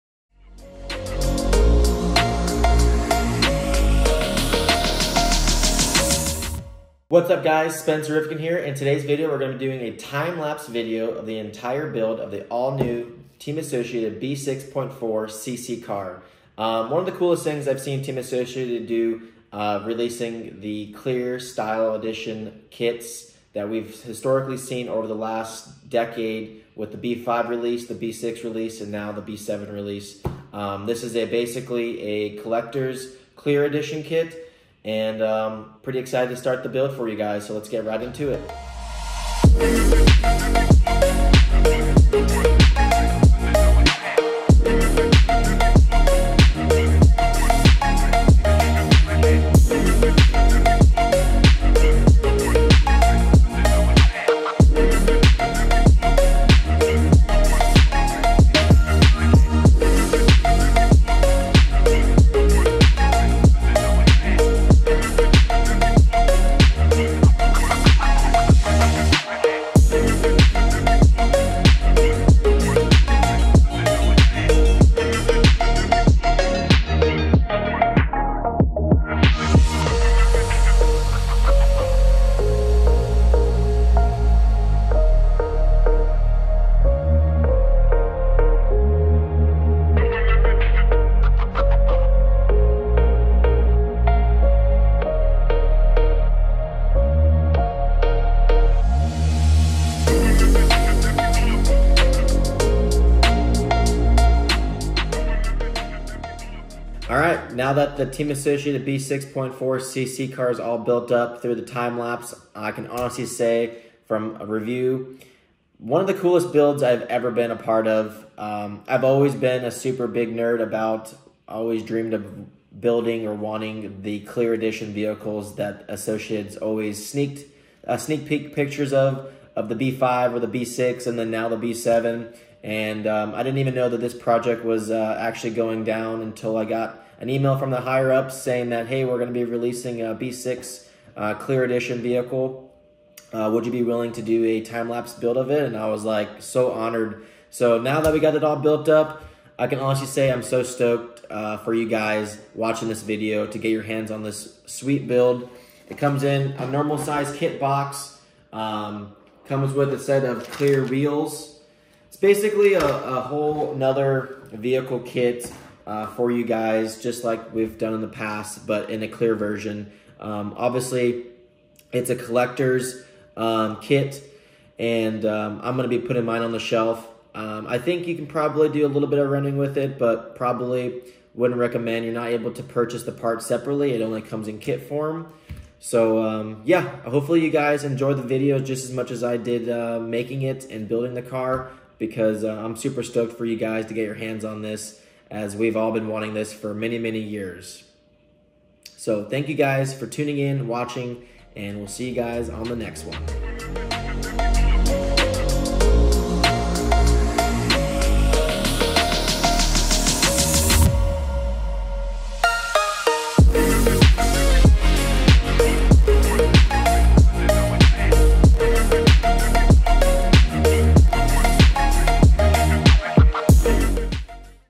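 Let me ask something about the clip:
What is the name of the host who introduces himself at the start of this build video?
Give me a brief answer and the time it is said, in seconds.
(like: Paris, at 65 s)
Spencer Rivkin, at 7 s.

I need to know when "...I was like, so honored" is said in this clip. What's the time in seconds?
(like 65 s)
145 s.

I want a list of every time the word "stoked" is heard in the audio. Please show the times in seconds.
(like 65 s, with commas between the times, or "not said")
150 s, 193 s.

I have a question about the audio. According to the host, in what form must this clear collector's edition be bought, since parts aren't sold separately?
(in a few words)
kit form.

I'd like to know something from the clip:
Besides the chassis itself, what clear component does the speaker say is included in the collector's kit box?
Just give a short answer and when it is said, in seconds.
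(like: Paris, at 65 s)
clear wheels, at 160 s.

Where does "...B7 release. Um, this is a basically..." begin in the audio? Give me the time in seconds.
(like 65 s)
29 s.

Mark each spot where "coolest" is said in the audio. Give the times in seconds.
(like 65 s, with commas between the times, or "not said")
17 s, 116 s.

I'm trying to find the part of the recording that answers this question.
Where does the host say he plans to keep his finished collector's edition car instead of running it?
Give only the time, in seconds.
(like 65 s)
176 s.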